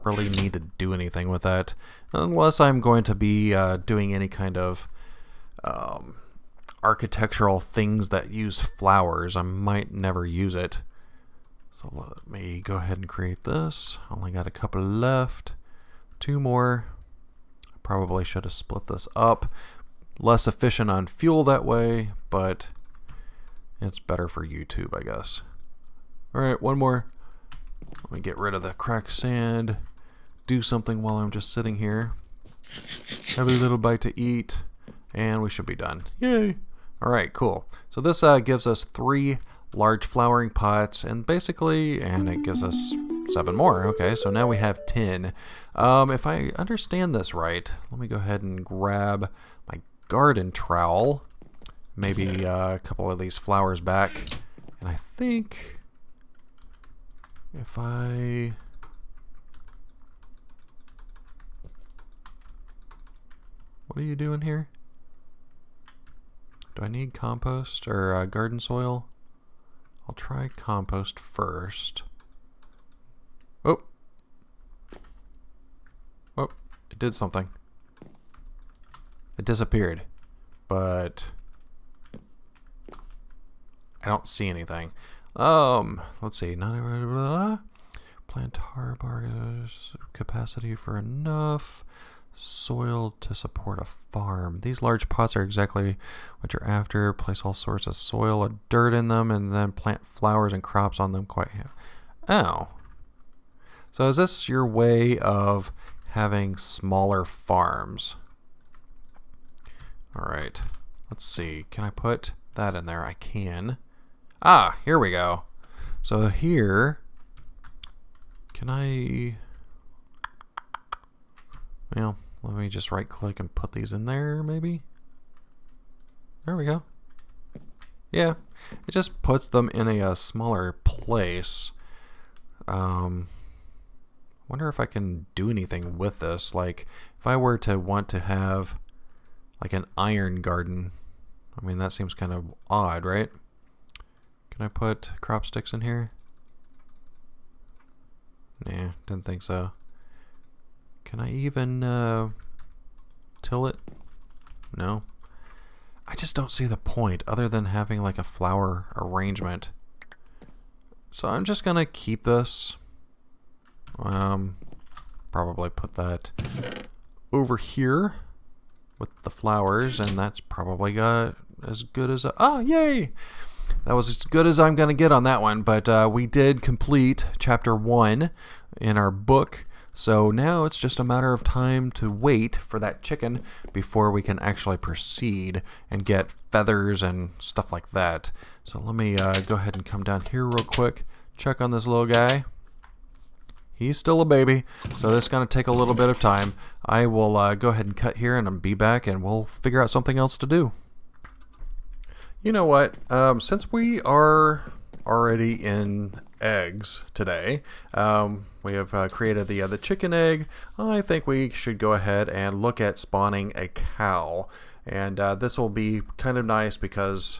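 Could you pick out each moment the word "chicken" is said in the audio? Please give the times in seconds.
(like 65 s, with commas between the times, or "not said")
183 s, 209 s.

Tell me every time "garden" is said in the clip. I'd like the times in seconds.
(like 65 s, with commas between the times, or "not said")
50 s, 68 s, 140 s.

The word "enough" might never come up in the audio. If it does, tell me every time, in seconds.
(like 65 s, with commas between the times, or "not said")
90 s.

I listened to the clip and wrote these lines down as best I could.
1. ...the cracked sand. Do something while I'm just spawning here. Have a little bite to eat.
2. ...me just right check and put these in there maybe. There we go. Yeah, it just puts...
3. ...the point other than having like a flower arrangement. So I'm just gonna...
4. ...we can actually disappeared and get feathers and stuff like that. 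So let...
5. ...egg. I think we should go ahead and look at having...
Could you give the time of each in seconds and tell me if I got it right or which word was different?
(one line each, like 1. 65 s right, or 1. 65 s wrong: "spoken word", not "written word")
1. 28 s wrong: "sitting", not "spawning"
2. 122 s wrong: "click", not "check"
3. 156 s right
4. 184 s wrong: "proceed", not "disappeared"
5. 210 s wrong: "spawning", not "having".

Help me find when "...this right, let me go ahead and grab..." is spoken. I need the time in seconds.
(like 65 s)
47 s.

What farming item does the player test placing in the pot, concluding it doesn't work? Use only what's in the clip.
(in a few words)
Crop sticks.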